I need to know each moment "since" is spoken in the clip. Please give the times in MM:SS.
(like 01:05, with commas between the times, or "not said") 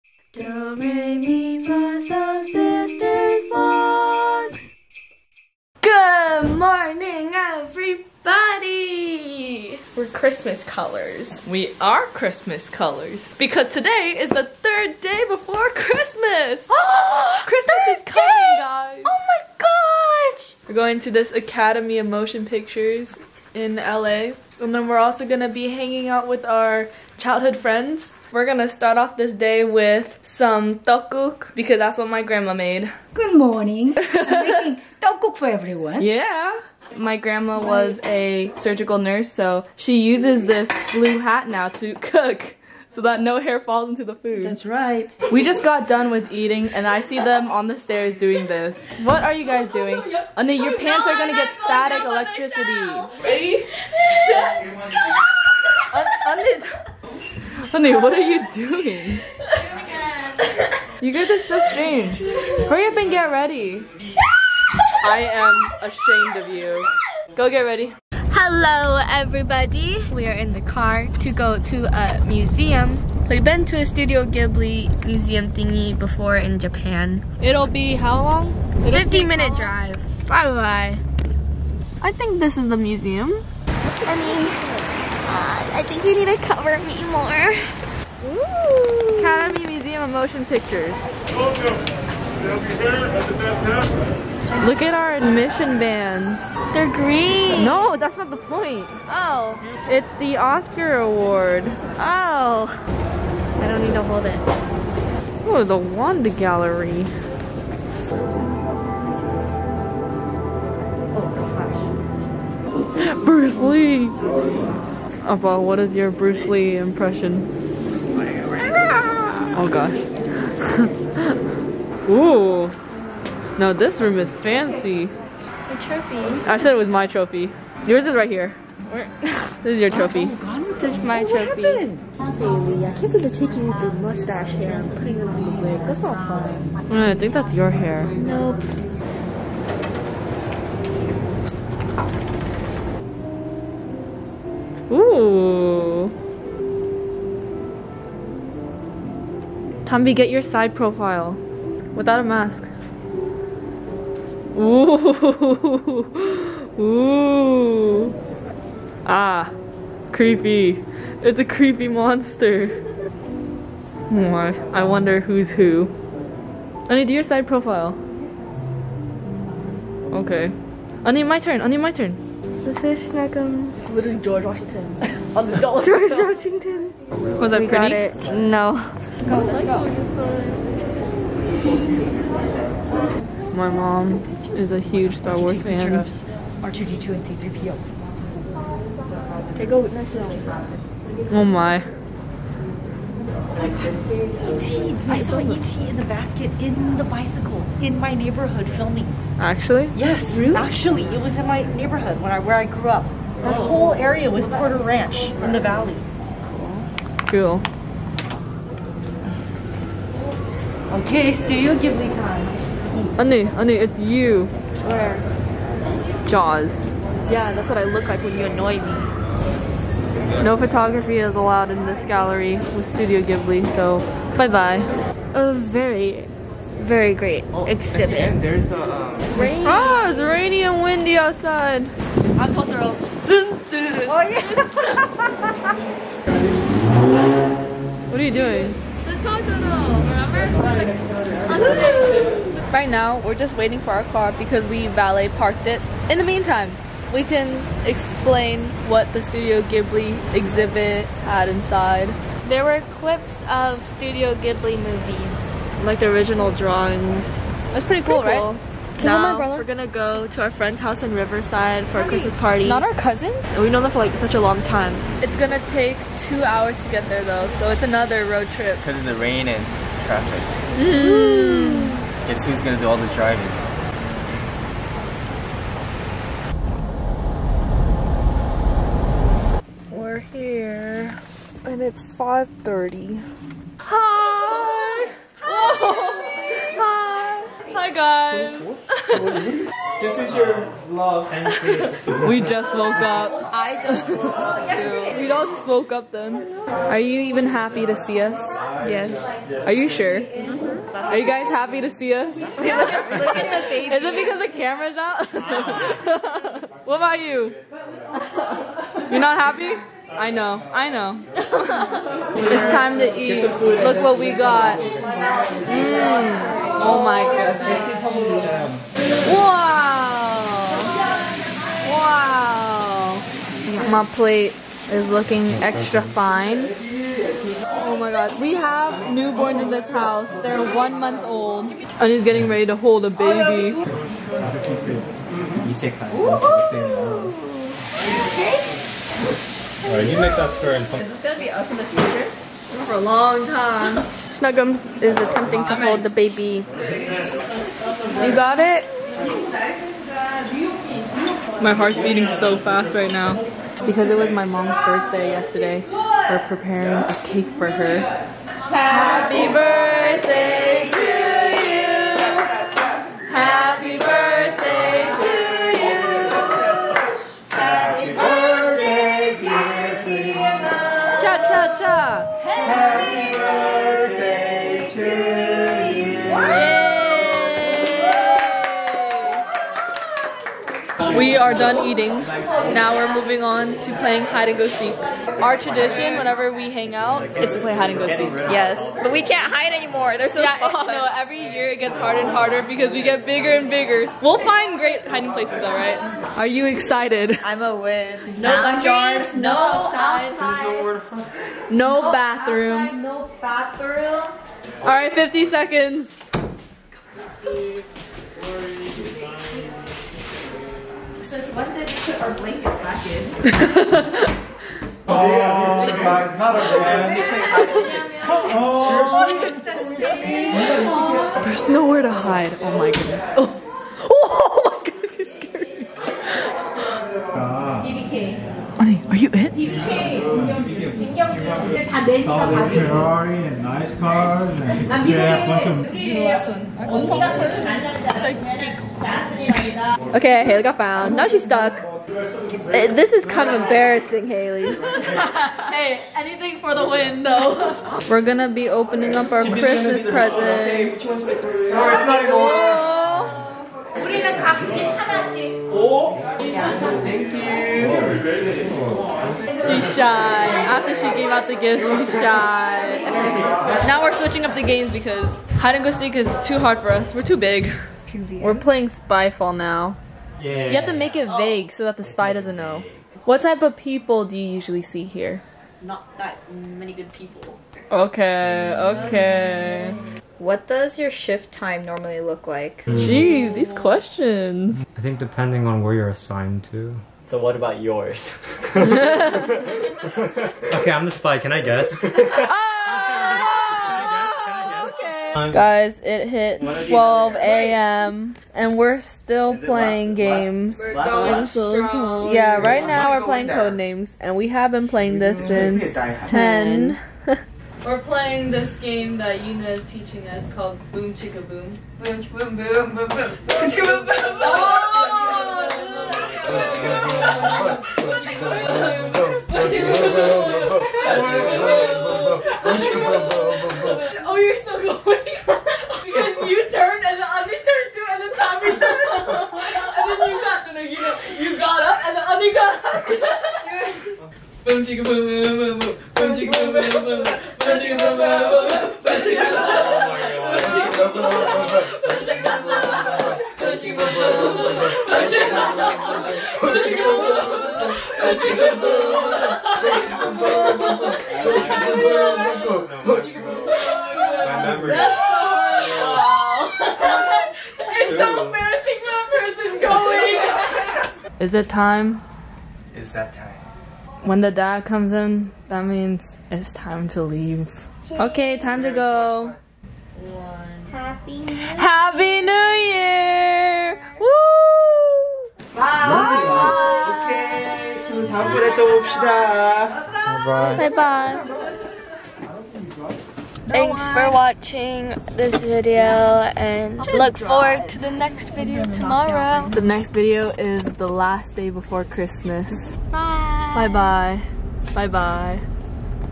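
06:51, 08:25.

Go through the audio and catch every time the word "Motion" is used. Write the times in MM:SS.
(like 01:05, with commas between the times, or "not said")
00:22, 01:30.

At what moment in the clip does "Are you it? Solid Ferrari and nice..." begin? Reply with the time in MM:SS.
07:09.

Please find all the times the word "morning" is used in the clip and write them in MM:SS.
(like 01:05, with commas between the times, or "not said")
00:06, 00:33.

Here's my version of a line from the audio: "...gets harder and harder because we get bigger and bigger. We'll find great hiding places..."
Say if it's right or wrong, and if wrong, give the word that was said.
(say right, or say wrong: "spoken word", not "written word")
right.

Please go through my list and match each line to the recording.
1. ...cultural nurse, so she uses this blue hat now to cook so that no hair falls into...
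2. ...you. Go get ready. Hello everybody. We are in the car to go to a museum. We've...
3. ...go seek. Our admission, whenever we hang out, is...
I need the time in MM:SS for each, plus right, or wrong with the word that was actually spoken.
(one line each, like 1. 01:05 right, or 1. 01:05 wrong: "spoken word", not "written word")
1. 00:38 wrong: "surgical", not "cultural"
2. 01:06 right
3. 06:24 wrong: "tradition", not "admission".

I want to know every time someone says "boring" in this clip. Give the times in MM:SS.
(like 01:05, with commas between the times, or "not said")
not said.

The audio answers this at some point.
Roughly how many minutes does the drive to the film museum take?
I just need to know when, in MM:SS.
01:19.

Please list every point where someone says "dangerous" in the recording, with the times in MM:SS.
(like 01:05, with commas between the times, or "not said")
not said.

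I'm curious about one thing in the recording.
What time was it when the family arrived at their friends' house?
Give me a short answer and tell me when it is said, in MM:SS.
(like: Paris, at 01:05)
5:30, at 04:42.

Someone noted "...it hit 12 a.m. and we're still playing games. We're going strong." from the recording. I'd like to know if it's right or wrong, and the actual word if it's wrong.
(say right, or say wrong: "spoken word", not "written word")
right.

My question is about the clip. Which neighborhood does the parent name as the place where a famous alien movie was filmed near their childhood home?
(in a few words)
Porter Ranch.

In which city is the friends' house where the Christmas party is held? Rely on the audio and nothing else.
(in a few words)
Riverside.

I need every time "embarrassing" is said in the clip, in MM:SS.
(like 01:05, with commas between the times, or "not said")
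07:23, 09:18.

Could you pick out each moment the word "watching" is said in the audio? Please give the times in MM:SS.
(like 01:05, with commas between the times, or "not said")
09:44.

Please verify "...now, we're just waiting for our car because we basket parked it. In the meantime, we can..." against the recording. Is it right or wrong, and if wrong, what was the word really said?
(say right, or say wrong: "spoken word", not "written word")
wrong: "valet", not "basket".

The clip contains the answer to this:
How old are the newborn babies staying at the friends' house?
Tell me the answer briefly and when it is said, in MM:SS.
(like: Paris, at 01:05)
one month old, at 05:30.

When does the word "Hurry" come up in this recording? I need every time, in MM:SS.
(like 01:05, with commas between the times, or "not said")
01:02.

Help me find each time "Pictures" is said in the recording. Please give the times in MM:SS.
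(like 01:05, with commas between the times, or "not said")
00:22, 01:30.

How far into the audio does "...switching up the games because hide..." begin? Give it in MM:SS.
07:44.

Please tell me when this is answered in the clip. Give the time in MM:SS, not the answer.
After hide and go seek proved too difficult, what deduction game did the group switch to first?
07:48.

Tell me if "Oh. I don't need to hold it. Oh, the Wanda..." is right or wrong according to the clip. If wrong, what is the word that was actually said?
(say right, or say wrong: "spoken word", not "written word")
right.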